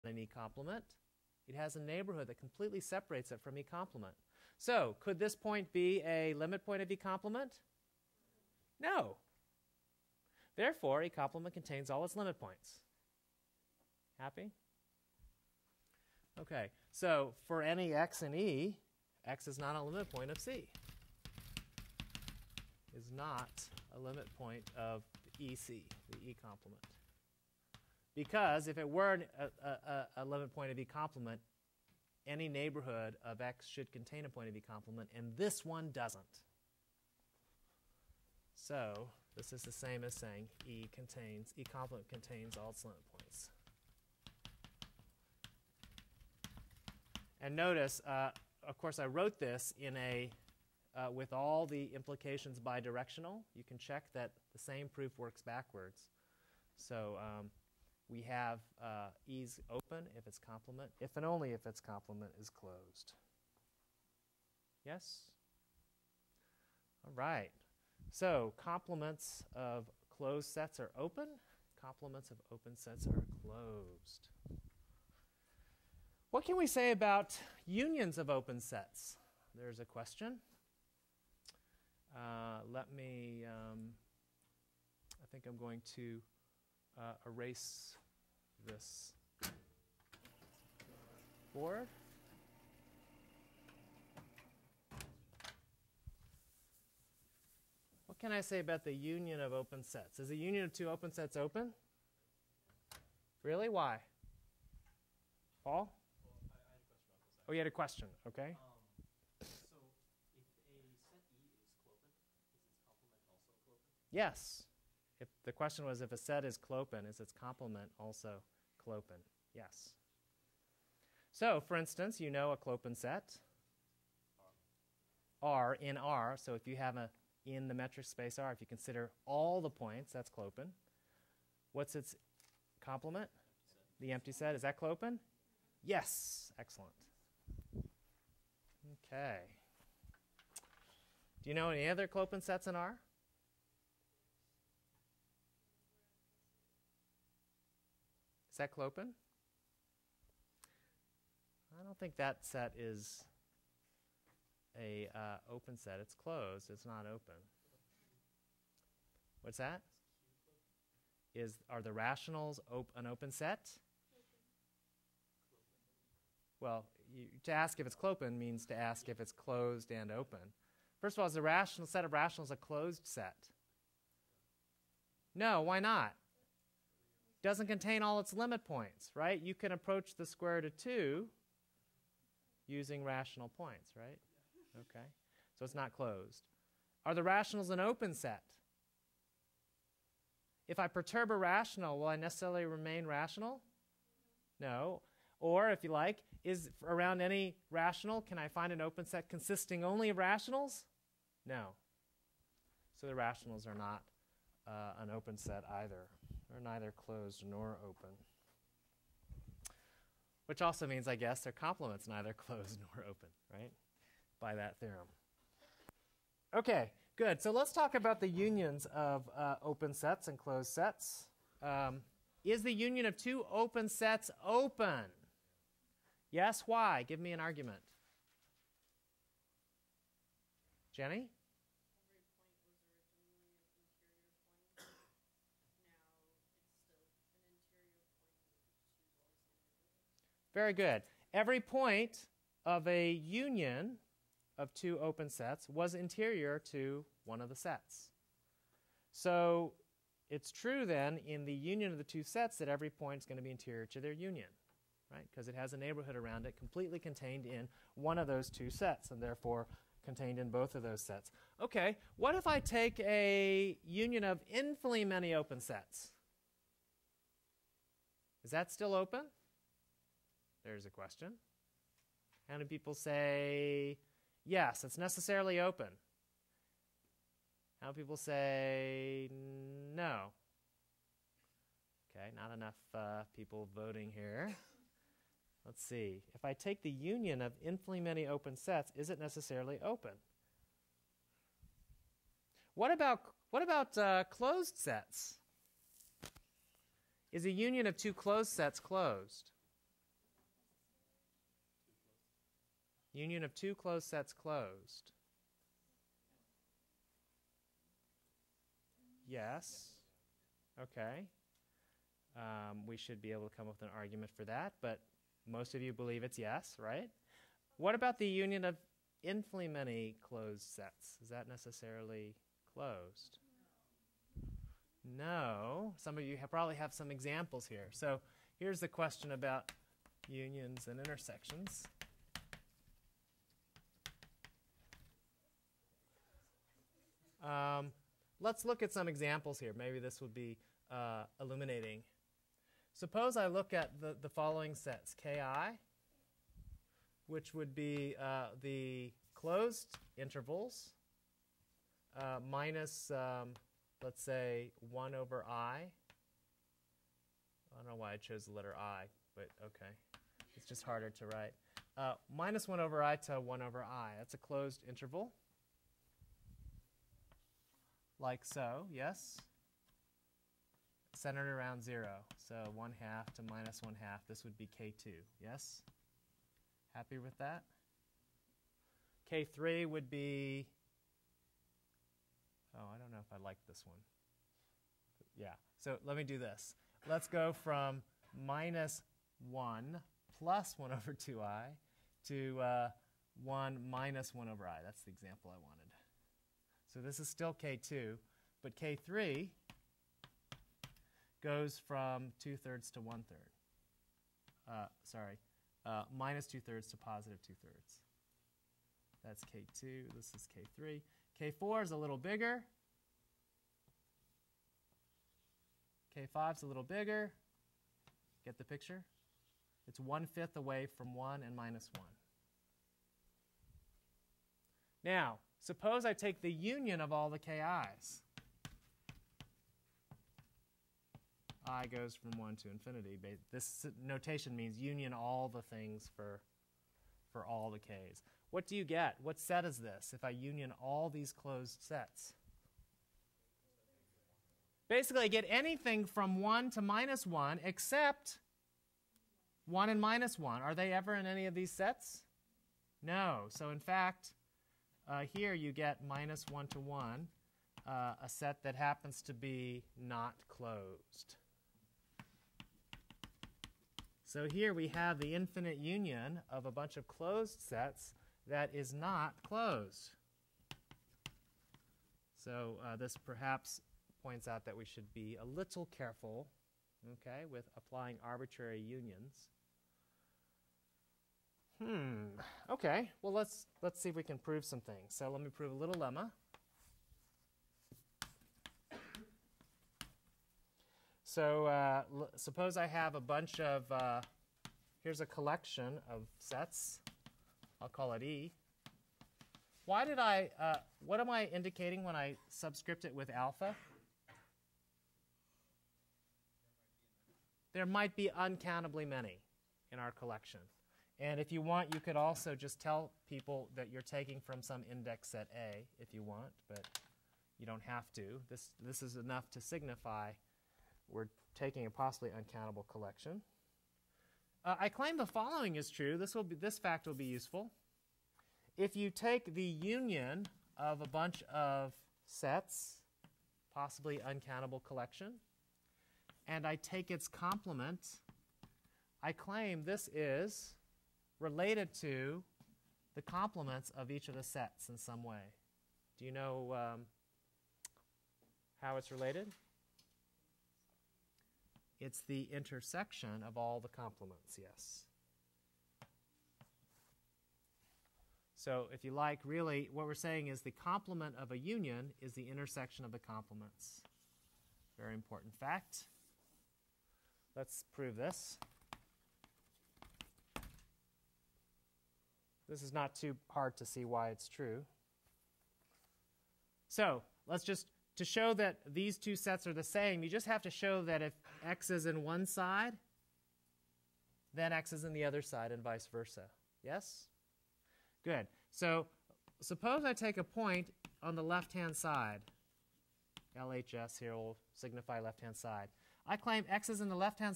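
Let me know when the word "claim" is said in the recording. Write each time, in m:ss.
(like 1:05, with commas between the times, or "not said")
8:44, 8:59, 9:56.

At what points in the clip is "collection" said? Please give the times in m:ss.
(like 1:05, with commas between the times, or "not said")
8:15, 8:30, 8:42, 8:54.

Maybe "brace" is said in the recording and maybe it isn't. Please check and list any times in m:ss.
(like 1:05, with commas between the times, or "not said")
not said.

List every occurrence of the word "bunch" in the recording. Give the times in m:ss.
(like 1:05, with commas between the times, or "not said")
7:46, 8:13, 8:51.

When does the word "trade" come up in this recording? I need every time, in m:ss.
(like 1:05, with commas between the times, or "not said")
not said.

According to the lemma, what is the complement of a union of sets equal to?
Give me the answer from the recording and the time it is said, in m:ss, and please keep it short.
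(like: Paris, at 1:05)
Intersection of the complements, at 9:22.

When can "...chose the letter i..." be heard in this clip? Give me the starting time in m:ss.
5:58.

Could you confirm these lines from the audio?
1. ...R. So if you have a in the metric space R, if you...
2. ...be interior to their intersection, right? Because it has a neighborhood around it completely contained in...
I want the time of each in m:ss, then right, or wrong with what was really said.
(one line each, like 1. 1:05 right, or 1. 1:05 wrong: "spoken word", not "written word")
1. 2:05 right
2. 4:13 wrong: "union", not "intersection".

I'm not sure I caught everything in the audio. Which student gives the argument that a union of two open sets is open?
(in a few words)
Jenny.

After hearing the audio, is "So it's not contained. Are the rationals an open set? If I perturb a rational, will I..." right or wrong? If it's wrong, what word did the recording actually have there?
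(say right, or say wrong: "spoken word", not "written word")
wrong: "closed", not "contained".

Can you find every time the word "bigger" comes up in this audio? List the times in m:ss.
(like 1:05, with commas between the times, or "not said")
6:52, 6:56.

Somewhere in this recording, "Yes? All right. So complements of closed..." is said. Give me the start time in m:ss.
1:04.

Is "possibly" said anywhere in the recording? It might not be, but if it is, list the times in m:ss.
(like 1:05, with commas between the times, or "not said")
8:41, 8:53.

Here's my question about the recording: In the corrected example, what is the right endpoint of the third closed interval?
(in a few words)
2/3.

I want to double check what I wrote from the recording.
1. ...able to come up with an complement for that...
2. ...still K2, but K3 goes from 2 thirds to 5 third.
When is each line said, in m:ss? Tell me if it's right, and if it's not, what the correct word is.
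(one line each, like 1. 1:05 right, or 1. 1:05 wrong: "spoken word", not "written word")
1. 5:13 wrong: "argument", not "complement"
2. 6:37 wrong: "1", not "5".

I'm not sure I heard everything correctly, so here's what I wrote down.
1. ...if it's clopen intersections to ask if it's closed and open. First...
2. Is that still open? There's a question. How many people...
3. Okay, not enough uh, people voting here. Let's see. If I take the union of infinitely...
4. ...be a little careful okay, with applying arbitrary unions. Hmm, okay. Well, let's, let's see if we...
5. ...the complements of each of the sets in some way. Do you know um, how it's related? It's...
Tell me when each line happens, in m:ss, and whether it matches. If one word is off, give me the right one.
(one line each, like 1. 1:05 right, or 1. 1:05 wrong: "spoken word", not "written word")
1. 2:47 wrong: "means", not "intersections"
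2. 4:28 right
3. 4:42 right
4. 7:55 right
5. 9:03 right.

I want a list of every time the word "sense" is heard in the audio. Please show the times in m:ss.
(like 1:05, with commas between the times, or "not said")
not said.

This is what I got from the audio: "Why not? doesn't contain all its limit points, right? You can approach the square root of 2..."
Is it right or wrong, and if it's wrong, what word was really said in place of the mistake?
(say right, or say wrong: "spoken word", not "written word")
right.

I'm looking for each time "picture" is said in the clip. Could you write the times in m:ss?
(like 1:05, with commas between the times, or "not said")
6:58.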